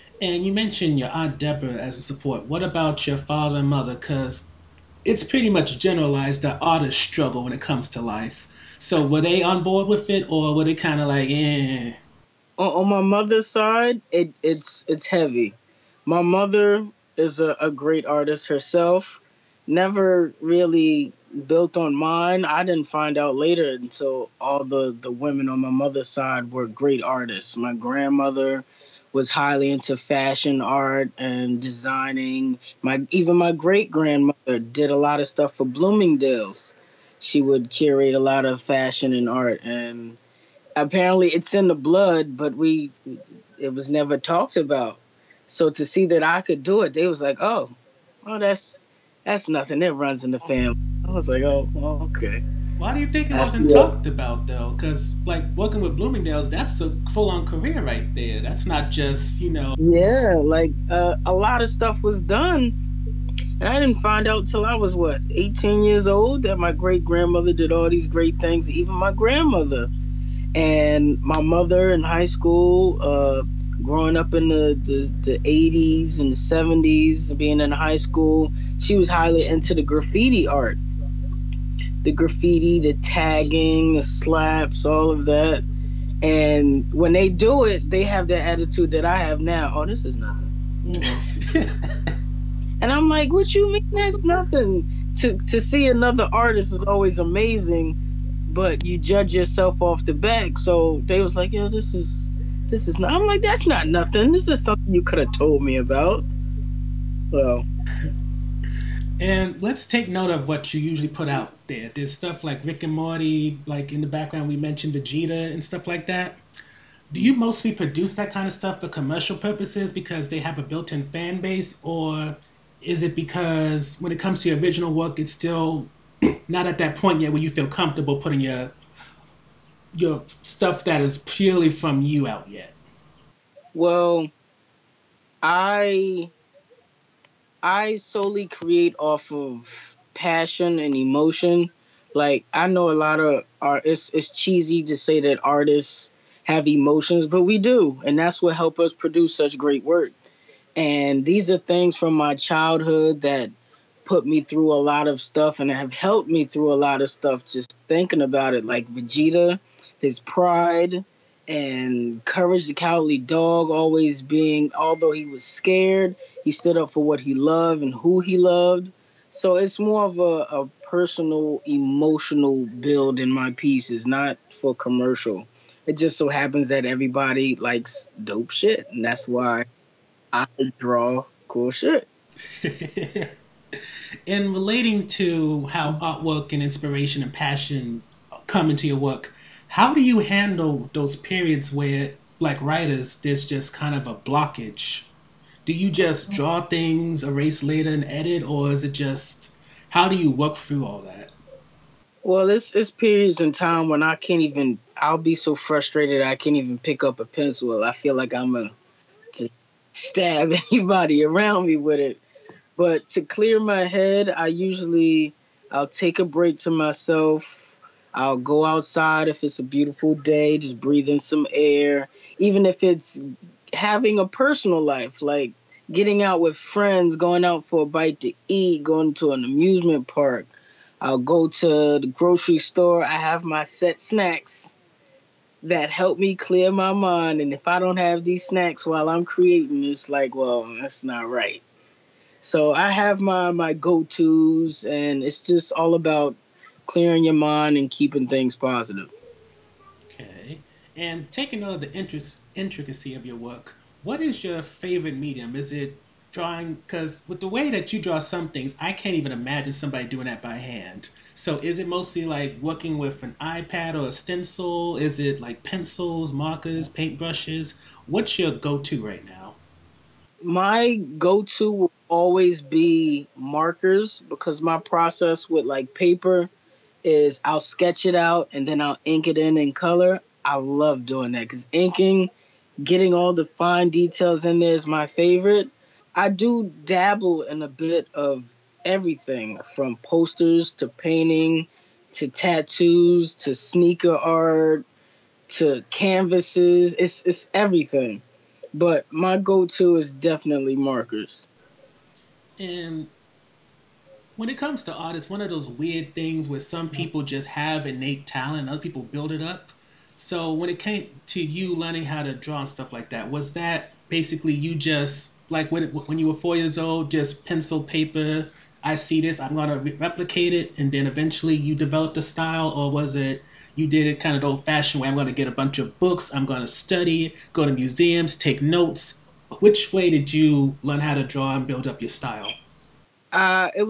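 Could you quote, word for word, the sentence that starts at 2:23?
It's it's cheesy to say that artists have emotions, but we do, and that's what help us produce such great work.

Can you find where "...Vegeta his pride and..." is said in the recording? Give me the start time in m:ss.
2:38.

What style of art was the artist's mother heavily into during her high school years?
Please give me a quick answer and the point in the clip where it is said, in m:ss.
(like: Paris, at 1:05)
graffiti art, at 1:19.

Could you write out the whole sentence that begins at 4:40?
I love doing that because inking, getting all the fine details in there is my favorite.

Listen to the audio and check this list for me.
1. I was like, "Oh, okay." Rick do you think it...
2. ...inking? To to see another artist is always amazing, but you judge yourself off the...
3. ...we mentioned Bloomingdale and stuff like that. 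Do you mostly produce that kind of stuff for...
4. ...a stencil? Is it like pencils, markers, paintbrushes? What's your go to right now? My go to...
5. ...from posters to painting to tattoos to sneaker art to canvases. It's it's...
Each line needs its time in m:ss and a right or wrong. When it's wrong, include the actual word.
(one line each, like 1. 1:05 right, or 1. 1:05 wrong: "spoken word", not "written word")
1. 0:51 wrong: "Why", not "Rick"
2. 1:34 wrong: "nothing", not "inking"
3. 1:54 wrong: "Vegeta", not "Bloomingdale"
4. 4:24 right
5. 4:49 right.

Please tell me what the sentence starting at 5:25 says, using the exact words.
I'm gonna get a bunch of books, I'm gonna study, go to museums, take notes.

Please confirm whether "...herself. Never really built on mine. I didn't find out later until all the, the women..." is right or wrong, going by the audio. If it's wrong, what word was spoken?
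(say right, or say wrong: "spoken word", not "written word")
right.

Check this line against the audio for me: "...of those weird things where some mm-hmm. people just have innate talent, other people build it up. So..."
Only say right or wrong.
right.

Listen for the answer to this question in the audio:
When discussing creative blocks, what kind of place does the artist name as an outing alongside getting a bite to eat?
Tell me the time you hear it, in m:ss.
3:49.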